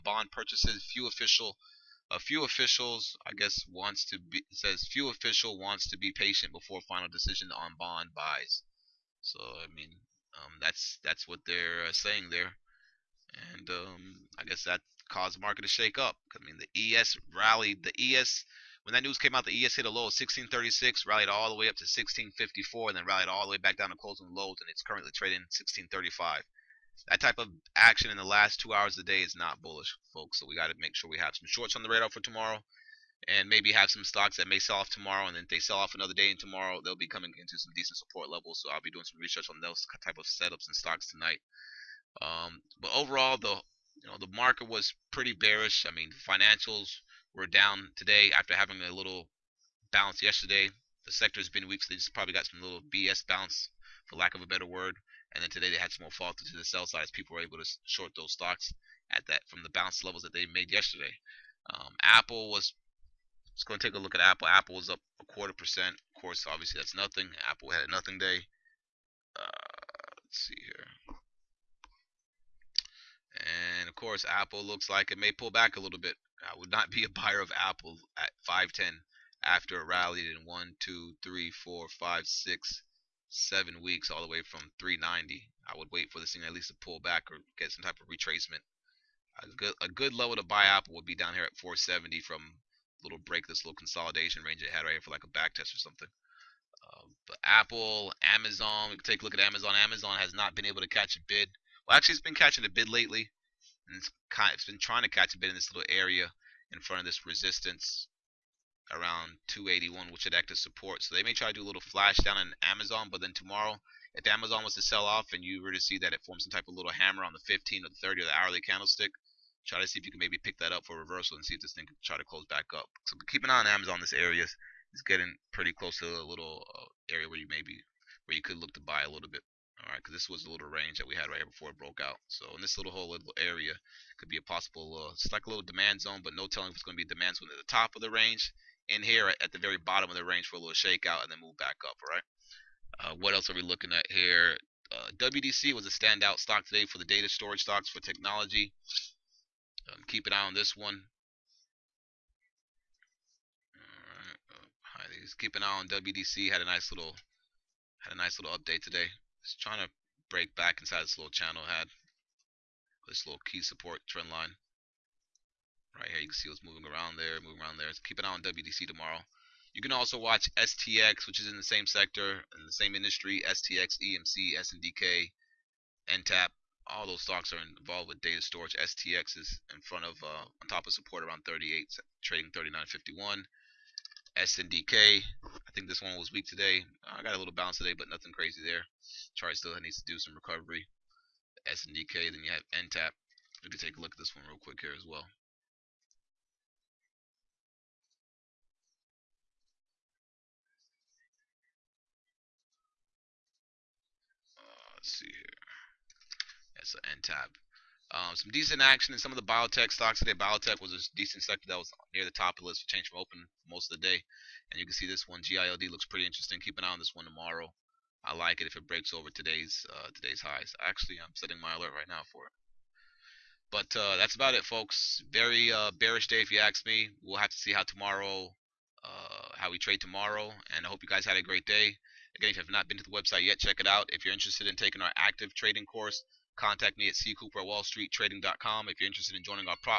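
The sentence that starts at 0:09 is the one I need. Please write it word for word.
So I mean, um, that's that's what they're uh, saying there, and um, I guess that caused the market to shake up.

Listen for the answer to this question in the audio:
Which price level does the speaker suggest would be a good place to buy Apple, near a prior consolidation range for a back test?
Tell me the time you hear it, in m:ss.
1:31.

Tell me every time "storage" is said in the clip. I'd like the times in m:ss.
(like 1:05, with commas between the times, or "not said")
2:27, 2:58.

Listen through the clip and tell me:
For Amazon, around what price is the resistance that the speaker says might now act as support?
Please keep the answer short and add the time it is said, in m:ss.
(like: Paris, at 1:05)
281, at 1:49.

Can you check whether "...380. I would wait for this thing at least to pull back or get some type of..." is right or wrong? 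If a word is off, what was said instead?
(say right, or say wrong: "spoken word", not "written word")
wrong: "390", not "380".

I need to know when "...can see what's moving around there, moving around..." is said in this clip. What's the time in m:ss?
2:46.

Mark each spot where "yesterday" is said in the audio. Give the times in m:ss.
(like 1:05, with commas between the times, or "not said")
0:50, 1:00.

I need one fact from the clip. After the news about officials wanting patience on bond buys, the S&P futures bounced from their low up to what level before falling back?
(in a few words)
1654.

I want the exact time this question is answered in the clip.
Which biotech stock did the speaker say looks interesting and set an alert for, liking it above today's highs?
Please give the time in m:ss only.
3:35.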